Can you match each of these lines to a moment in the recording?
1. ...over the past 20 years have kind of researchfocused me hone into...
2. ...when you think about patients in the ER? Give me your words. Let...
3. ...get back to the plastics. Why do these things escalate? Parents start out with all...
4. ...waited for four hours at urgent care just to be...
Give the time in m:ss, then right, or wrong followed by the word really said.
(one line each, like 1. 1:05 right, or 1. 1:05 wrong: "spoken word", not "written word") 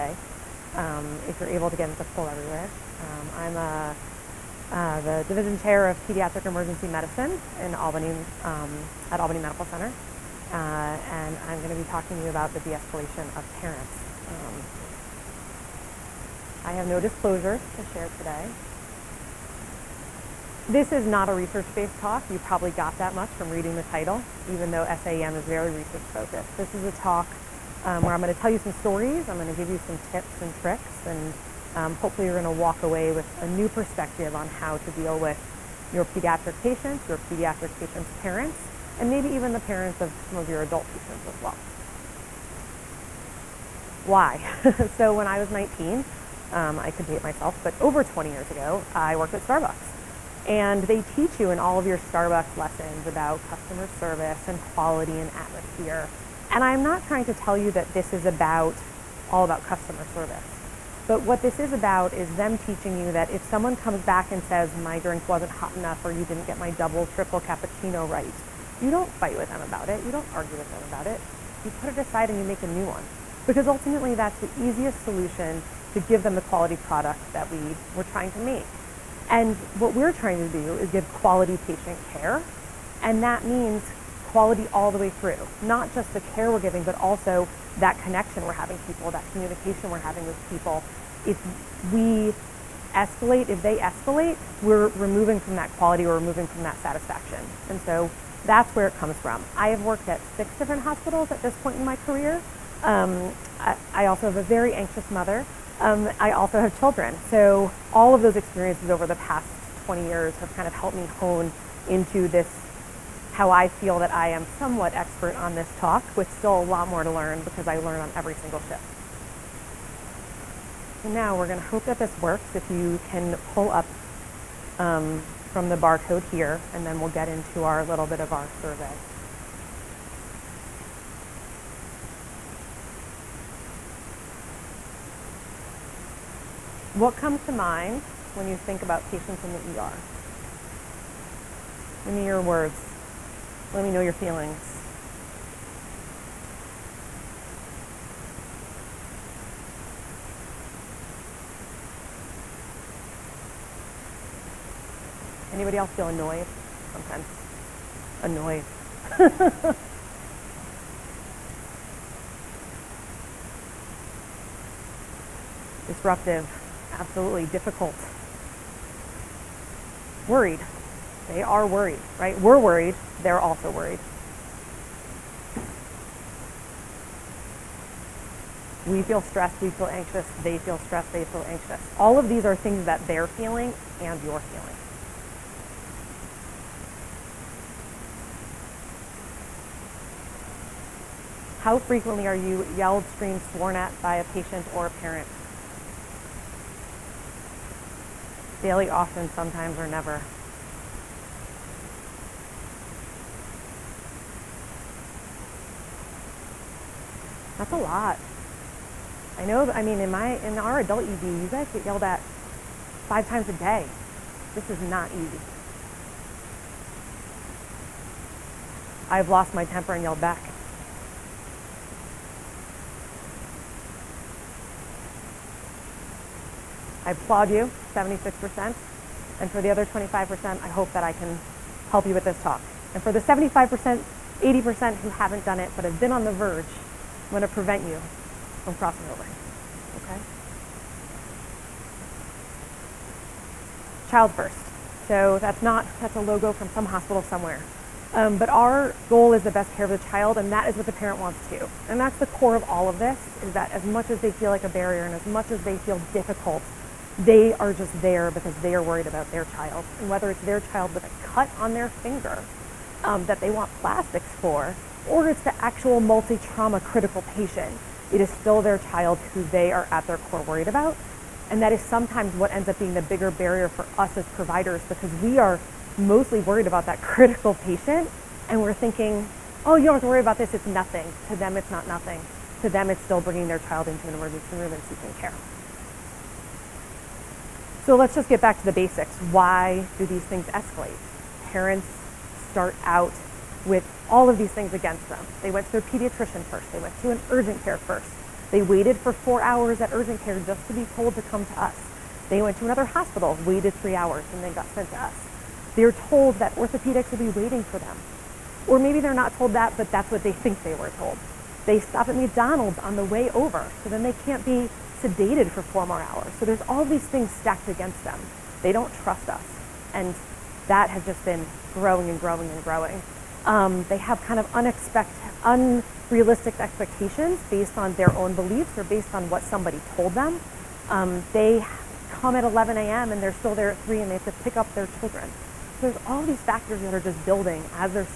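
1. 1:48 wrong: "helped", not "researchfocused"
2. 2:18 right
3. 4:48 wrong: "basics", not "plastics"
4. 4:58 right.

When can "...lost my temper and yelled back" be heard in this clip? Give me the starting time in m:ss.
3:39.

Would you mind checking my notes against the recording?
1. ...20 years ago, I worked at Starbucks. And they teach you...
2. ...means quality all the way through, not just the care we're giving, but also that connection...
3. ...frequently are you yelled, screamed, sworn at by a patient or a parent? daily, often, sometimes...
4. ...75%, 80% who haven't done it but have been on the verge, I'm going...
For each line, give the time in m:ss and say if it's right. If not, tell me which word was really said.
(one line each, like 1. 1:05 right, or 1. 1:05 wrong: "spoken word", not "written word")
1. 0:48 right
2. 1:23 right
3. 3:11 right
4. 3:53 right.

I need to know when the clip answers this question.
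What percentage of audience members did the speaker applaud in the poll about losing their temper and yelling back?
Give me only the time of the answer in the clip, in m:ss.
3:47.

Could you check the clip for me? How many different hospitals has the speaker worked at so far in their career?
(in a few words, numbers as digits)
6.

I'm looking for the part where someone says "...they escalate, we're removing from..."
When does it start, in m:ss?
1:33.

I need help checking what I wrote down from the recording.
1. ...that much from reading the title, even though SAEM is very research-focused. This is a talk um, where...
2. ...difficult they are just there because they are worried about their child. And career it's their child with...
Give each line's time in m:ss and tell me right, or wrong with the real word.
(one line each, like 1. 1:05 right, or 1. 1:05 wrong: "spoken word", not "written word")
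1. 0:22 right
2. 4:16 wrong: "whether", not "career".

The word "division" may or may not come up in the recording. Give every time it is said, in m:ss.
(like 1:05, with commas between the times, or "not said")
0:05.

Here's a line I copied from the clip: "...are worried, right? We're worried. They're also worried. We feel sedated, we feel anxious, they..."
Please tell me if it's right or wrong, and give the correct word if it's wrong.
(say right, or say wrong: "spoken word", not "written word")
wrong: "stressed", not "sedated".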